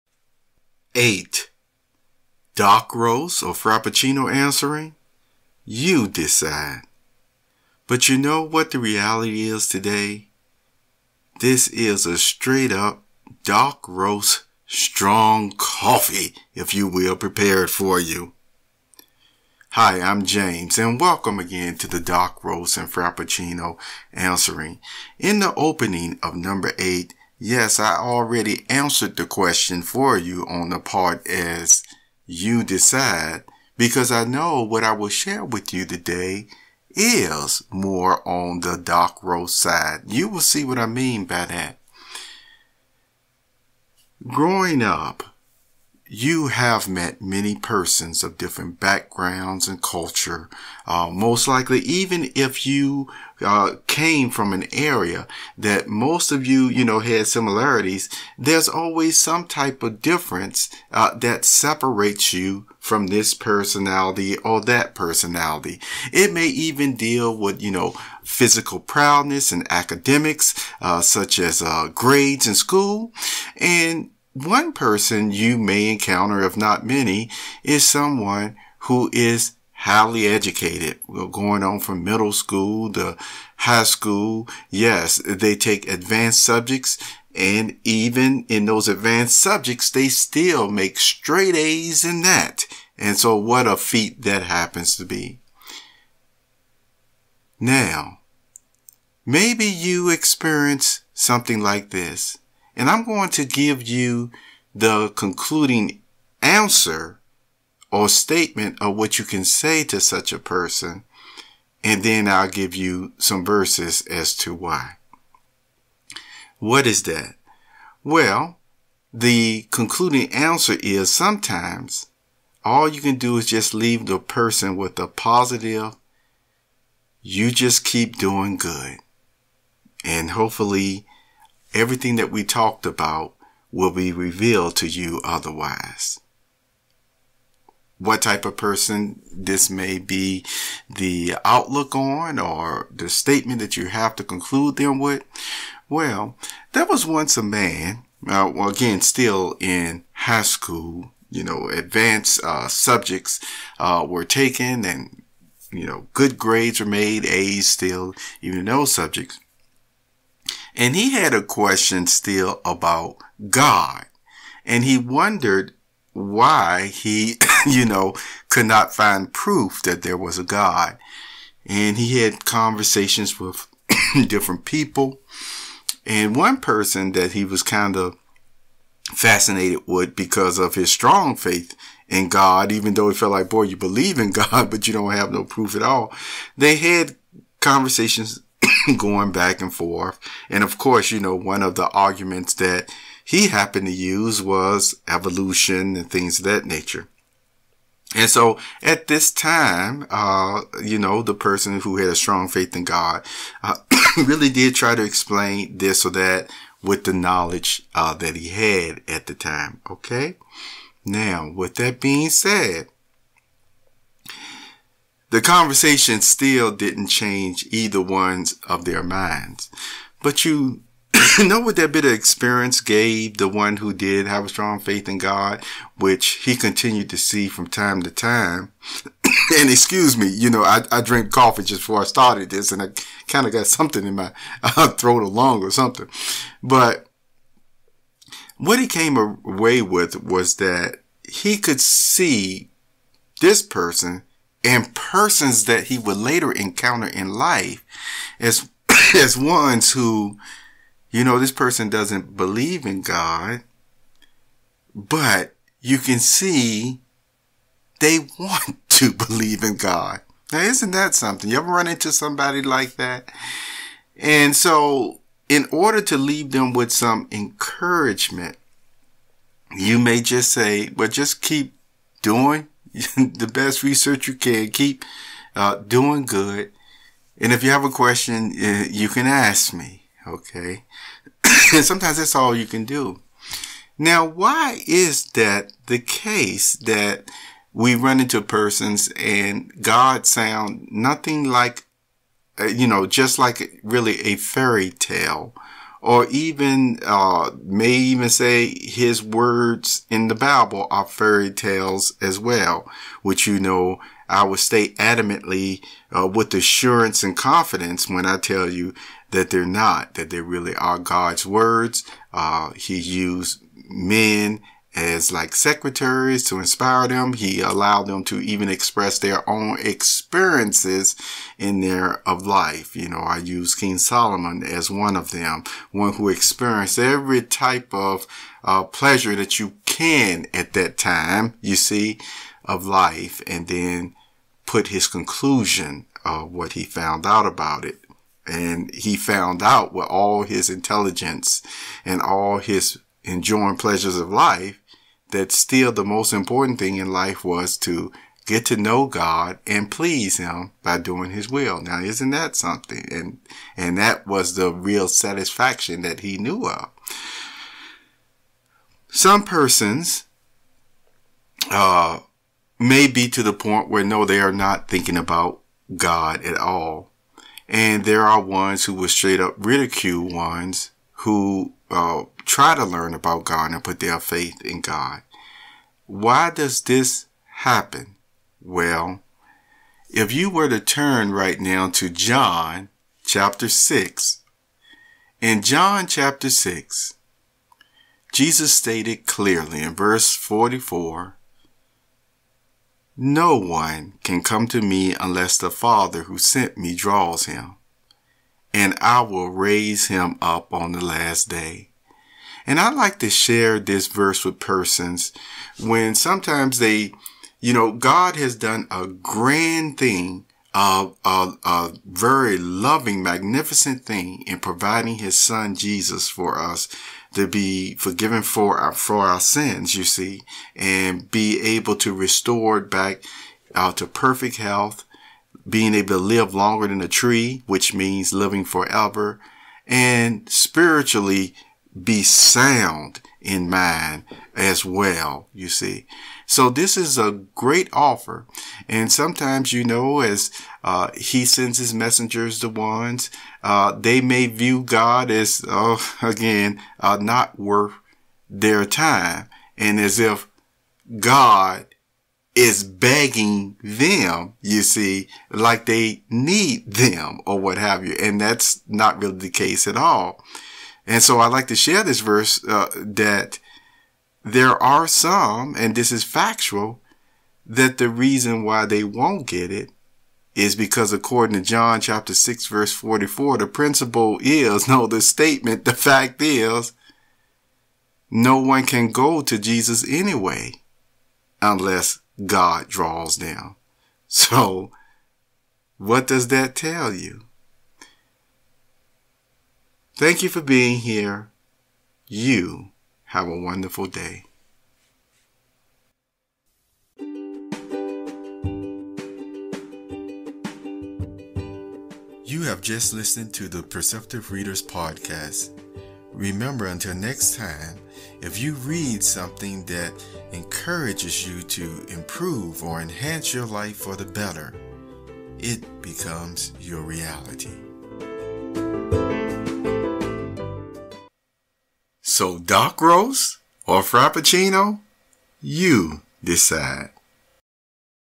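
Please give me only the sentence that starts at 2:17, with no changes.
What type of person this may be the outlook on or the statement that you have to conclude them with.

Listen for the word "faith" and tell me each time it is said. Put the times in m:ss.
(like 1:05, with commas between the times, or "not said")
3:01, 3:22, 3:44, 6:14.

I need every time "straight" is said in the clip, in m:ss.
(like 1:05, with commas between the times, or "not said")
0:12, 1:30, 6:09.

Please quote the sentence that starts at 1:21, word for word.
going on from middle school to high school.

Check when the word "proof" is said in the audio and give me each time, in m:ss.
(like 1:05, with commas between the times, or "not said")
2:49, 3:05.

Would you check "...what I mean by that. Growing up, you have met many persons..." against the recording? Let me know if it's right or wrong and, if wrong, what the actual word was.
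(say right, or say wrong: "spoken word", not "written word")
right.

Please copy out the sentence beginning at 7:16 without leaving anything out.
So this is a great offer.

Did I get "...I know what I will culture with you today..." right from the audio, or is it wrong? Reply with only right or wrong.
wrong.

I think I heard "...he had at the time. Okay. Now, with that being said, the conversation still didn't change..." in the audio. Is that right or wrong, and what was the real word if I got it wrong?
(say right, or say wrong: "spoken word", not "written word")
right.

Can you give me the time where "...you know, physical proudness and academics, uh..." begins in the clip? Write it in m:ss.
1:07.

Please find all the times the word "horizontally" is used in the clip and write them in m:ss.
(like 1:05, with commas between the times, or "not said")
not said.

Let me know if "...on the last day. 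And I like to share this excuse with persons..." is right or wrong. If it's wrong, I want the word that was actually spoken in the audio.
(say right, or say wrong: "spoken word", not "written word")
wrong: "verse", not "excuse".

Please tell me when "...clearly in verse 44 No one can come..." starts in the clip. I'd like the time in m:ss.
6:29.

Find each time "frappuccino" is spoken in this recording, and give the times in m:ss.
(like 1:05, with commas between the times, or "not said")
0:03, 0:22, 8:44.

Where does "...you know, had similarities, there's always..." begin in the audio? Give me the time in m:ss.
0:56.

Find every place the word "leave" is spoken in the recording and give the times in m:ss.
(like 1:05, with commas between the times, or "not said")
2:03, 4:26.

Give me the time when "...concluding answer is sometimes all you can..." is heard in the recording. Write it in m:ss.
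1:59.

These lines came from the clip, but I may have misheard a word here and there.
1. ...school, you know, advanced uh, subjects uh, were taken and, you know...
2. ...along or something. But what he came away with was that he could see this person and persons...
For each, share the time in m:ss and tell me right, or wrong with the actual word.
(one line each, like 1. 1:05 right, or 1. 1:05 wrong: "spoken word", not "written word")
1. 2:30 right
2. 3:55 right.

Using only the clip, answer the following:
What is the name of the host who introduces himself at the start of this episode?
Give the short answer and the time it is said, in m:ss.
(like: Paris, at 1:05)
James, at 0:20.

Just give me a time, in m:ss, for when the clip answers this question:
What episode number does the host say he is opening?
0:26.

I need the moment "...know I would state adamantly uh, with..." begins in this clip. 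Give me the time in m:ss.
5:03.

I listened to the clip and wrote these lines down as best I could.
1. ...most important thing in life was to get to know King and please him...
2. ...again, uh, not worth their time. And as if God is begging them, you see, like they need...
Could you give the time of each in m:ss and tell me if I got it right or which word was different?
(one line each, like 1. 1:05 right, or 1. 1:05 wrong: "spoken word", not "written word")
1. 5:46 wrong: "God", not "King"
2. 7:26 right.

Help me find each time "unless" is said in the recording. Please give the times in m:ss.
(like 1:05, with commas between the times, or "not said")
6:35, 8:01.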